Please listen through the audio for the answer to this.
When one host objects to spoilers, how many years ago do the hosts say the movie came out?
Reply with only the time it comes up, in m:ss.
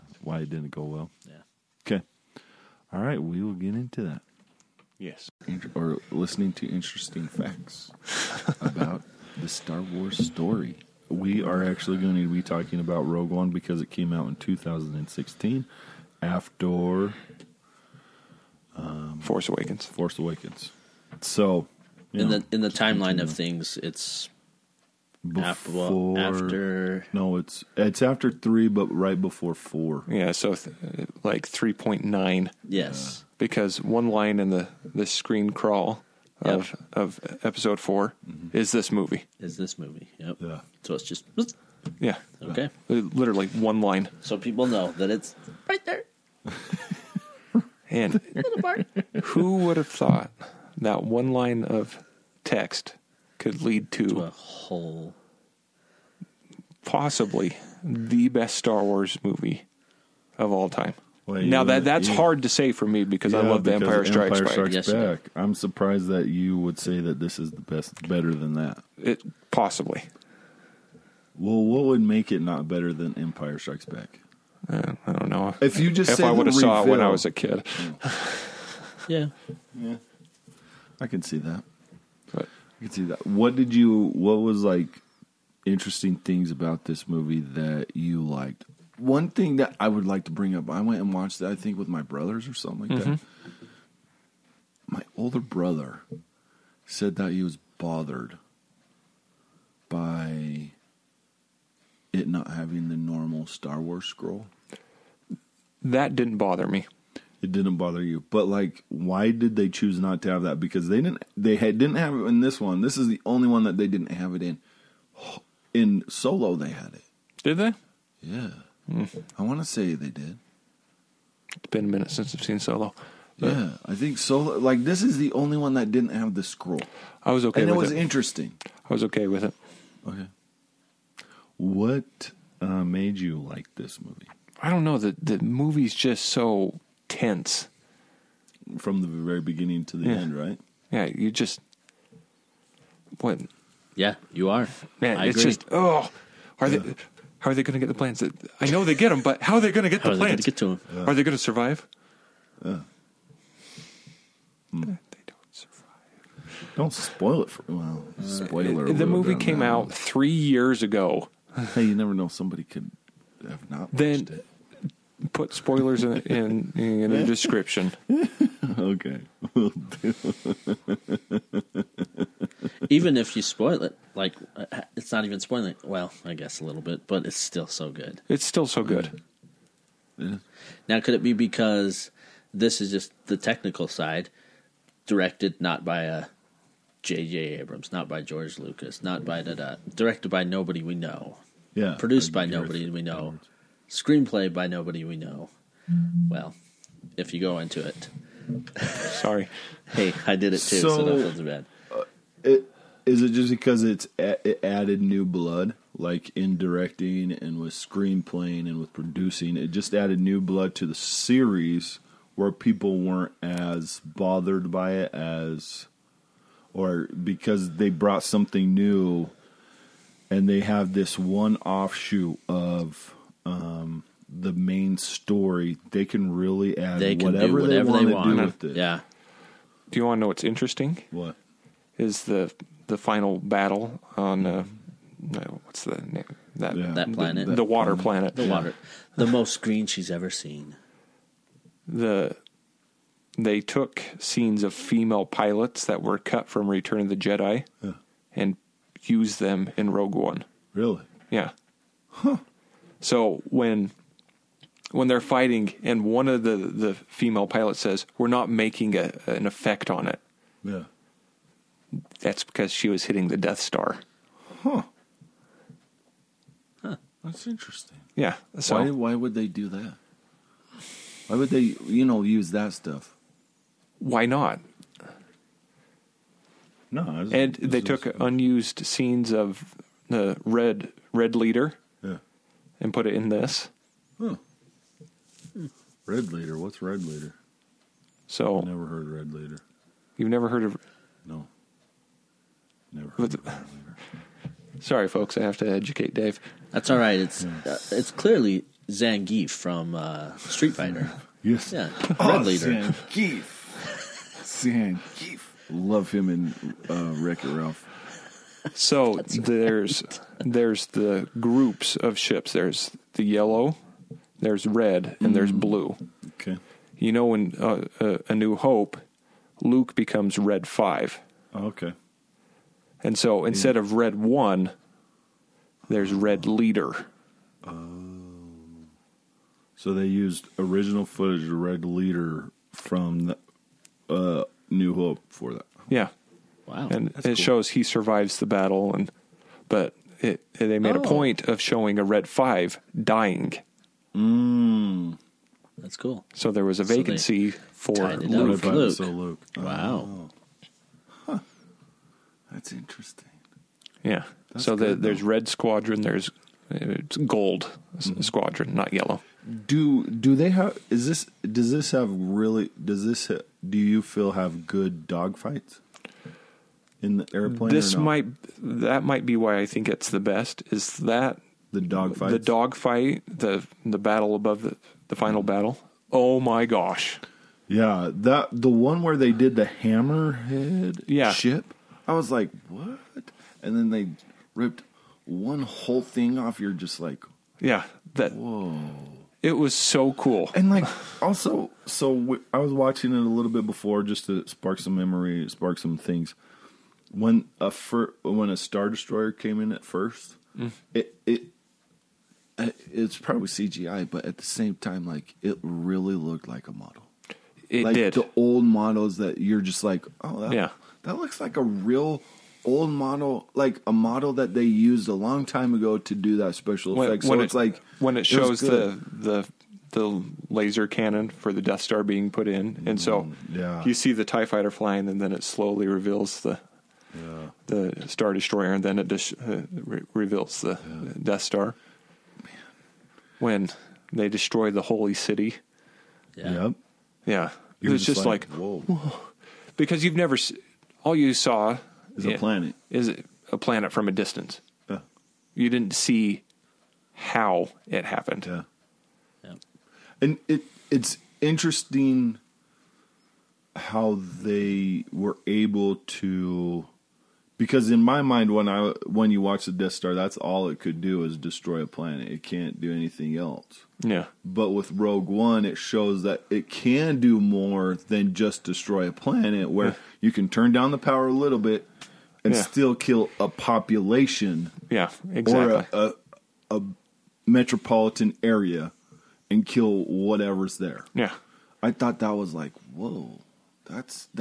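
2:39.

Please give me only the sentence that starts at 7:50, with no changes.
you can turn down the power a little bit and yeah.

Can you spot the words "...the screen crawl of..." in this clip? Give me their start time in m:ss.
0:34.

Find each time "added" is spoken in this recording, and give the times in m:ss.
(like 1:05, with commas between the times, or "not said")
3:24, 3:29.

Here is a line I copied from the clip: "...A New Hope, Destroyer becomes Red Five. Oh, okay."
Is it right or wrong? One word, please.
wrong.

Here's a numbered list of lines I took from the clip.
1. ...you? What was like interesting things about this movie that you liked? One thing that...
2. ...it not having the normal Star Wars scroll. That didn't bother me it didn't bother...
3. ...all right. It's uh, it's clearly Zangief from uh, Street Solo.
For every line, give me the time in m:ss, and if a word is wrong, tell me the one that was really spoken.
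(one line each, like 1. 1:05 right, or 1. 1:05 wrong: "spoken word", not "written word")
1. 1:23 right
2. 1:42 right
3. 4:56 wrong: "Fighter", not "Solo".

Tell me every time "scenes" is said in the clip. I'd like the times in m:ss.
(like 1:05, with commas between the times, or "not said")
4:04, 4:38.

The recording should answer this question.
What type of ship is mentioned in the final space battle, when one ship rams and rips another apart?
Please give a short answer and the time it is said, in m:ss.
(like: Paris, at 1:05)
hammerhead, at 6:19.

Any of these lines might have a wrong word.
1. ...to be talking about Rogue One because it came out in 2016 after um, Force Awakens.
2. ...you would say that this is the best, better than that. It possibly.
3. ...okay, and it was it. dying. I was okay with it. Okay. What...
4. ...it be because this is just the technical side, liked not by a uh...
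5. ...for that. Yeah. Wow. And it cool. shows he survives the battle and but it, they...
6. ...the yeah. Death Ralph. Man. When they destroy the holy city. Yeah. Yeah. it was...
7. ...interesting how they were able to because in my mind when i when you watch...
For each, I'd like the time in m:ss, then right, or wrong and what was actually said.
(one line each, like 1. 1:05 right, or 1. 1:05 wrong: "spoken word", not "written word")
1. 0:12 right
2. 1:06 right
3. 2:07 wrong: "interesting", not "dying"
4. 3:01 wrong: "directed", not "liked"
5. 5:35 right
6. 7:10 wrong: "Star", not "Ralph"
7. 7:31 right.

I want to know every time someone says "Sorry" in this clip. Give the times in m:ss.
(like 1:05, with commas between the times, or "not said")
3:19, 4:54.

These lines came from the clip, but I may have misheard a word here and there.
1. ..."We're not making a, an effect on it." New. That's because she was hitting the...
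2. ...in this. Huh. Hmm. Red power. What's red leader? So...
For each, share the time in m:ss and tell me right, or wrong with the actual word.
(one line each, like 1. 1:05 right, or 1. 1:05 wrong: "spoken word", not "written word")
1. 4:18 wrong: "Yeah", not "New"
2. 4:43 wrong: "leader", not "power".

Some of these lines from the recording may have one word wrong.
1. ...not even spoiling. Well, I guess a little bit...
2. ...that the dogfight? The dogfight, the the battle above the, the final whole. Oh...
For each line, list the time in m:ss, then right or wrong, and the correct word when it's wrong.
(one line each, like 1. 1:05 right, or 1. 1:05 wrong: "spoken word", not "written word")
1. 2:55 right
2. 6:10 wrong: "battle", not "whole".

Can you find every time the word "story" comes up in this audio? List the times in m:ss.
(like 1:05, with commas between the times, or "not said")
0:10, 3:44.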